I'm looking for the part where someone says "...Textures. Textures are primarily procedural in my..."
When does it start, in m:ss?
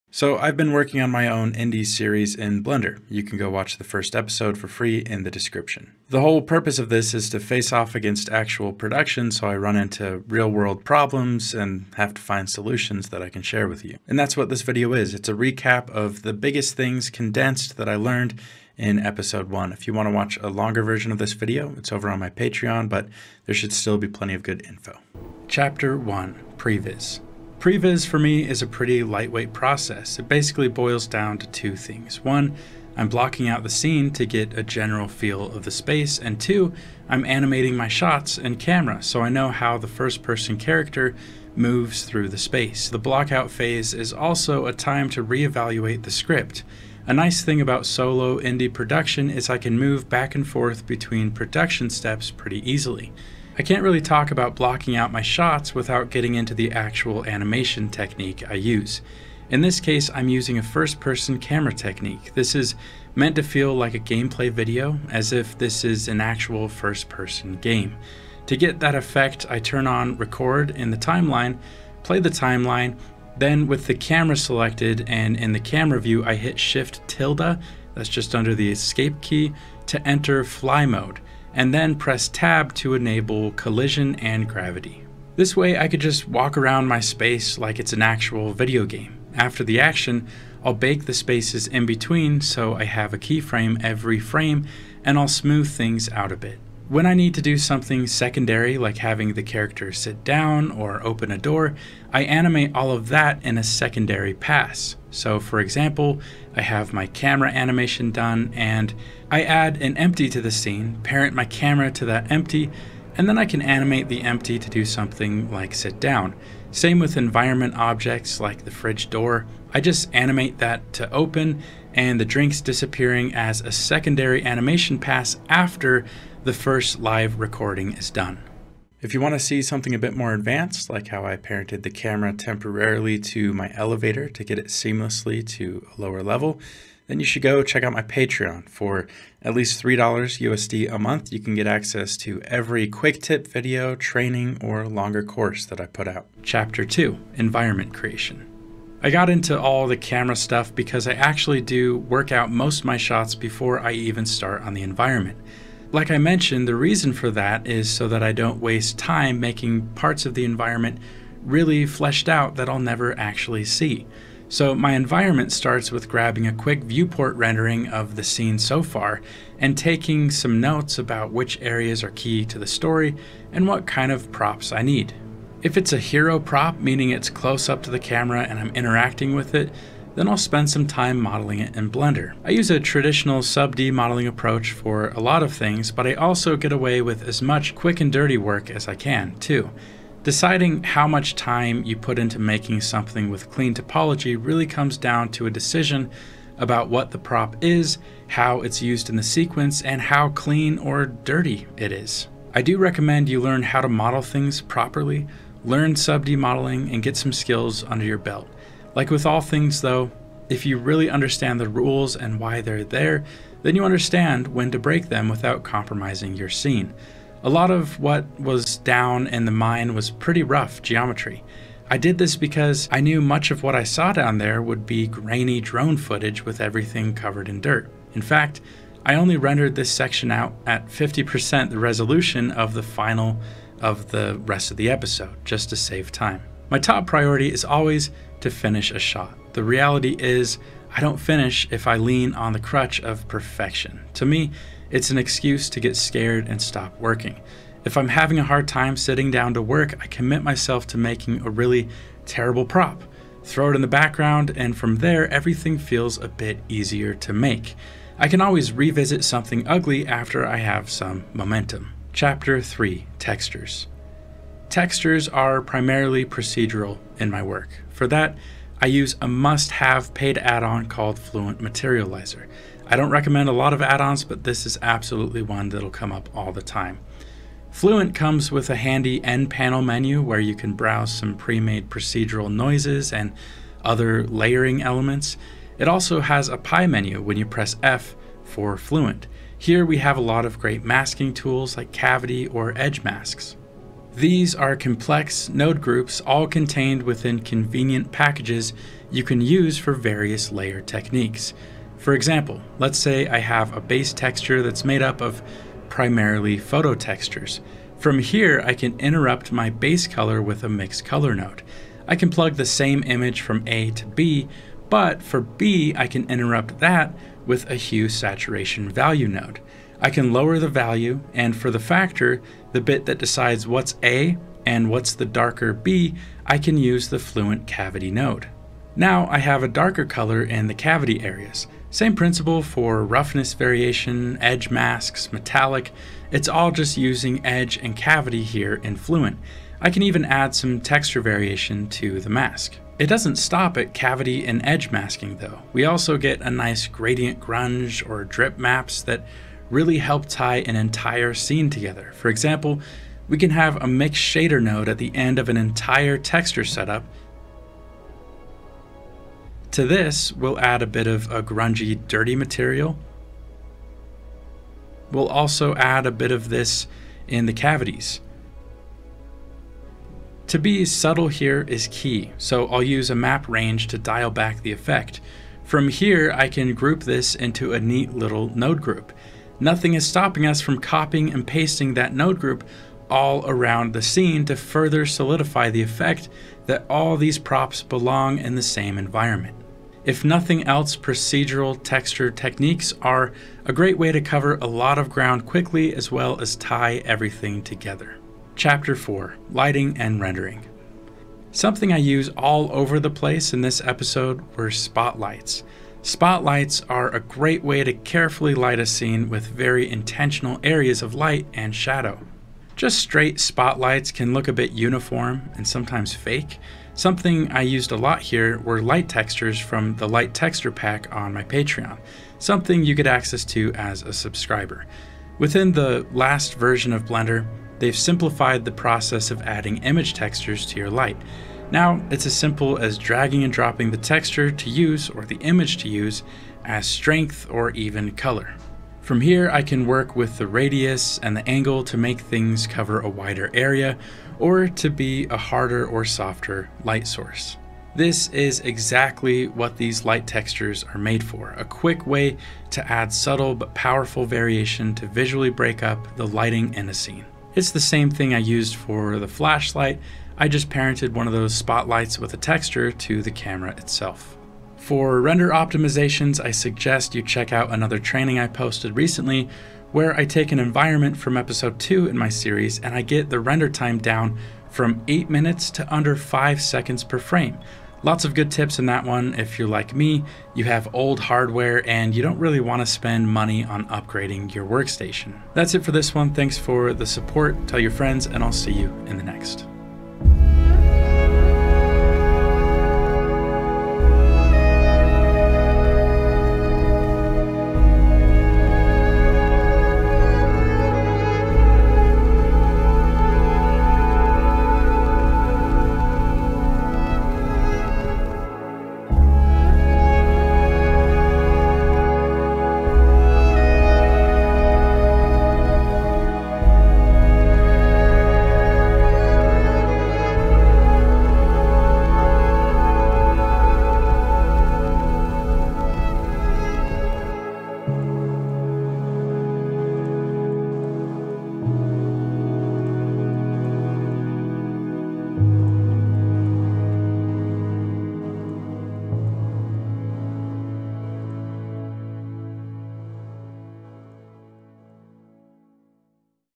4:23.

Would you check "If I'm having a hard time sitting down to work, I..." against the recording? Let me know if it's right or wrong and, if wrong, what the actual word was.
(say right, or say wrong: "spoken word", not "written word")
right.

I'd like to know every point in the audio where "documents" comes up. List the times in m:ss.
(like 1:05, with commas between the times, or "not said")
not said.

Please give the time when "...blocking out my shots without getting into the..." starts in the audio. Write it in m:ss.
0:54.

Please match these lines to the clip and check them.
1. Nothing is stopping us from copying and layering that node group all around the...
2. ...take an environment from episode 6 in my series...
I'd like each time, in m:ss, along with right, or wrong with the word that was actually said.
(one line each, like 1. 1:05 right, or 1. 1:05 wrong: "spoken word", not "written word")
1. 6:19 wrong: "pasting", not "layering"
2. 7:50 wrong: "2", not "6".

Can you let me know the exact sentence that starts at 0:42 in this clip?
The blockout phase is also a time to reevaluate the script.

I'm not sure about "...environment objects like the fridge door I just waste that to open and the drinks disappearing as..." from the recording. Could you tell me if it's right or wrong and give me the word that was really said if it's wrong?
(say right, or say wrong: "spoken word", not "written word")
wrong: "animate", not "waste".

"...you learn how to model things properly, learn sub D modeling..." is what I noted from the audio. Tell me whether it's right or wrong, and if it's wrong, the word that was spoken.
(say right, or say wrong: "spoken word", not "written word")
right.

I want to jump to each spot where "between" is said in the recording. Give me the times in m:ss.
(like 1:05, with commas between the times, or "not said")
0:50, 1:31.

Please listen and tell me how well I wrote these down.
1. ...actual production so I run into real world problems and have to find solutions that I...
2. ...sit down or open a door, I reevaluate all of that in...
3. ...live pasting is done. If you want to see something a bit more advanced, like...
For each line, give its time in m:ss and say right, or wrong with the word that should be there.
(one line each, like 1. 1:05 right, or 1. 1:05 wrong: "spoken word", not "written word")
1. 0:08 right
2. 1:39 wrong: "animate", not "reevaluate"
3. 2:06 wrong: "recording", not "pasting".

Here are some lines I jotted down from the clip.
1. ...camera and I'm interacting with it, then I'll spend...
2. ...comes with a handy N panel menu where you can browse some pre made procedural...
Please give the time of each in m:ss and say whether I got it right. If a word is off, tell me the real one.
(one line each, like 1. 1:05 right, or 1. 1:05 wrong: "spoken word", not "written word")
1. 2:57 right
2. 4:38 right.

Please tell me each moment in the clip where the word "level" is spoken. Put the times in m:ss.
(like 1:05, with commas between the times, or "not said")
2:16.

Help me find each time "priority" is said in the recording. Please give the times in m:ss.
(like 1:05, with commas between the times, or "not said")
3:57.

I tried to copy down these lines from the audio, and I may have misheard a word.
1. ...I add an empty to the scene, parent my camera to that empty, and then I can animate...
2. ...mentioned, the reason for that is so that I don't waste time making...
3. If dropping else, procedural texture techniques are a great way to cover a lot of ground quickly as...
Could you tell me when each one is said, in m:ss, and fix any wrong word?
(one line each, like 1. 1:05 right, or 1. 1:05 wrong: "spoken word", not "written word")
1. 1:49 right
2. 2:36 right
3. 6:30 wrong: "nothing", not "dropping".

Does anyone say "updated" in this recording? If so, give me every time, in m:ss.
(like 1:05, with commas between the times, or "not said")
not said.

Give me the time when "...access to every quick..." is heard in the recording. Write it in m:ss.
2:21.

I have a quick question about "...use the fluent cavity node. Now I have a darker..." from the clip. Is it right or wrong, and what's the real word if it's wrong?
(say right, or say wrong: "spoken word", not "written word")
right.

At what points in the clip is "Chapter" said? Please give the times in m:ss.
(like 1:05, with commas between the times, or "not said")
0:25, 2:26, 4:22, 6:38.